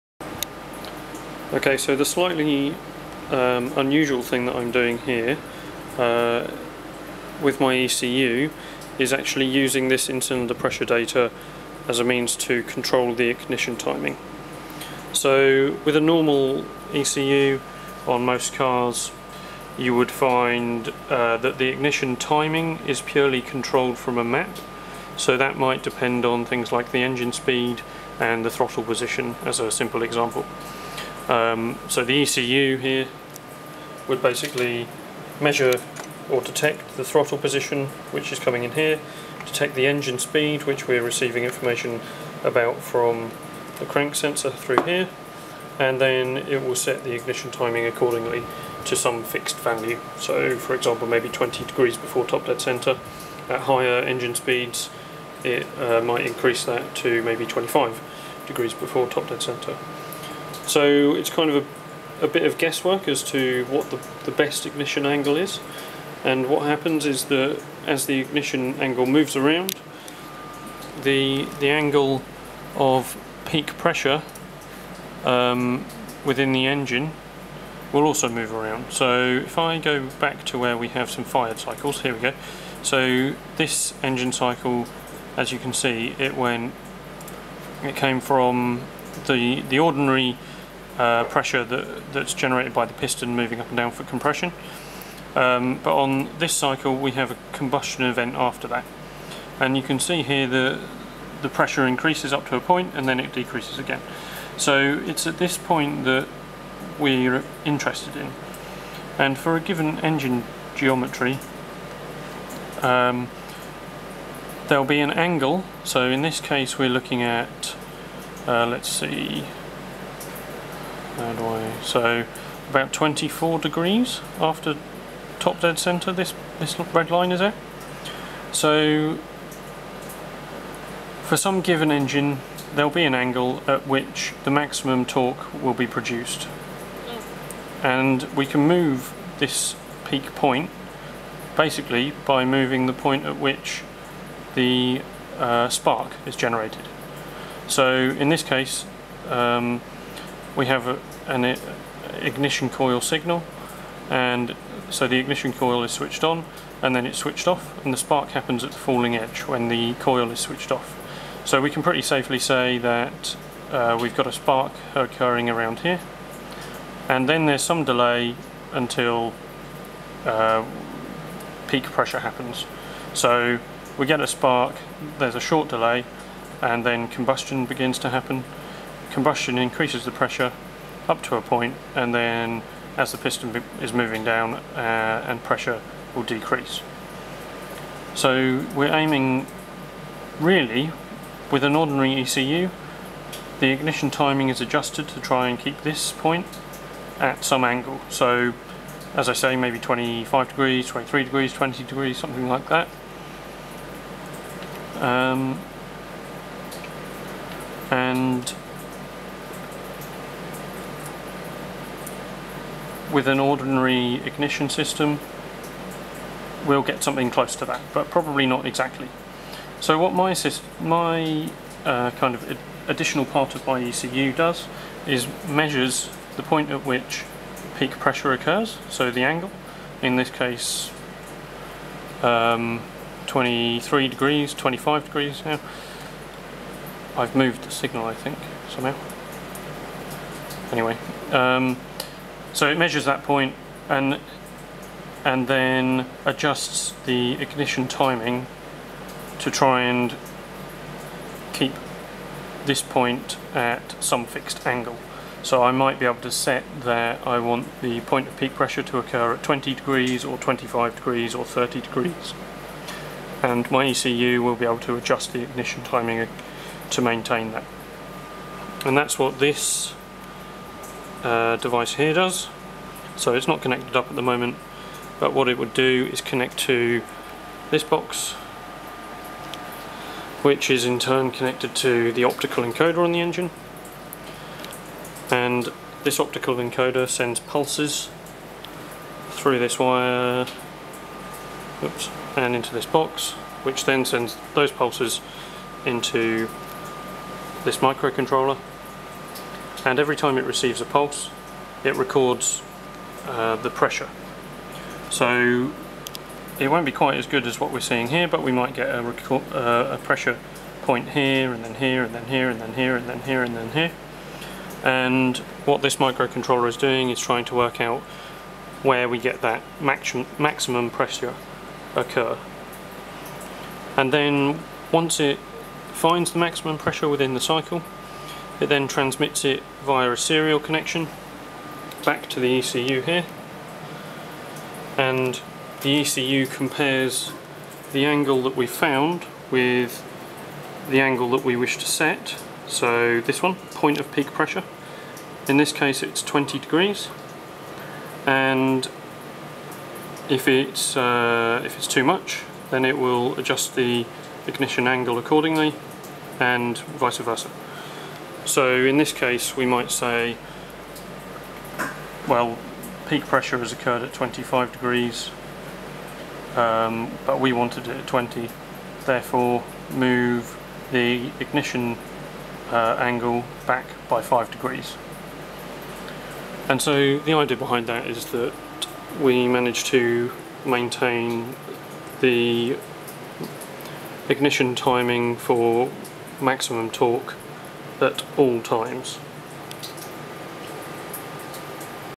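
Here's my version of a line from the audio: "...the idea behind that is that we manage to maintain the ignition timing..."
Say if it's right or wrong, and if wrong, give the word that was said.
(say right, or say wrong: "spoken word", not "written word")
right.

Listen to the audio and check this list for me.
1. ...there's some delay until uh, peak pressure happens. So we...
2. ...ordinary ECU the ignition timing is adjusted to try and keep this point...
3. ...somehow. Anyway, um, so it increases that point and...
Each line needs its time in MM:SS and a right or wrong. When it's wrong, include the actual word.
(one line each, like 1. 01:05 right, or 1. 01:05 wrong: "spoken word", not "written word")
1. 02:47 right
2. 03:11 right
3. 03:58 wrong: "measures", not "increases".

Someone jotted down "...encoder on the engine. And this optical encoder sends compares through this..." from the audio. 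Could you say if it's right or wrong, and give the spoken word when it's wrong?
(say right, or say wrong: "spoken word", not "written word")
wrong: "pulses", not "compares".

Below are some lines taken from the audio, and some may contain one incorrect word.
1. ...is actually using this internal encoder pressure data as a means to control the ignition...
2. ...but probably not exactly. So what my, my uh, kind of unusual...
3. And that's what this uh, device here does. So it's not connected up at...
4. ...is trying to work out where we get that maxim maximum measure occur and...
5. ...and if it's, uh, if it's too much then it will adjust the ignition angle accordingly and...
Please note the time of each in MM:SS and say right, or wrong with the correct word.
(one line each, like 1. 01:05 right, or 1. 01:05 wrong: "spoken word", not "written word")
1. 00:08 wrong: "cylinder", not "encoder"
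2. 03:37 wrong: "additional", not "unusual"
3. 04:28 right
4. 05:17 wrong: "pressure", not "measure"
5. 05:48 right.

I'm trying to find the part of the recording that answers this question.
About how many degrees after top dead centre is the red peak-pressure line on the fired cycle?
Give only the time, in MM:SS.
02:02.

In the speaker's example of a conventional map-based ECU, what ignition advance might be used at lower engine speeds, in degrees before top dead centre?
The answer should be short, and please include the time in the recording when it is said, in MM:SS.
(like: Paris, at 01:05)
20 degrees, at 00:51.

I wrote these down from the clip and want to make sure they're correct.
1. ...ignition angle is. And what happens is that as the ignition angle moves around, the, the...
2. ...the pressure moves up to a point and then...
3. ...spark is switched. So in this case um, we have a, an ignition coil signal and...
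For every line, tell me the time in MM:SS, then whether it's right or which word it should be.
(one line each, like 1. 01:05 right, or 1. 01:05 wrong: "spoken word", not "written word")
1. 01:04 right
2. 01:41 wrong: "increases", not "moves"
3. 02:25 wrong: "generated", not "switched".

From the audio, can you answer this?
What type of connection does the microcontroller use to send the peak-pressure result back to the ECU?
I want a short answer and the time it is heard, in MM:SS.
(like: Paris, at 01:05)
serial connection, at 05:30.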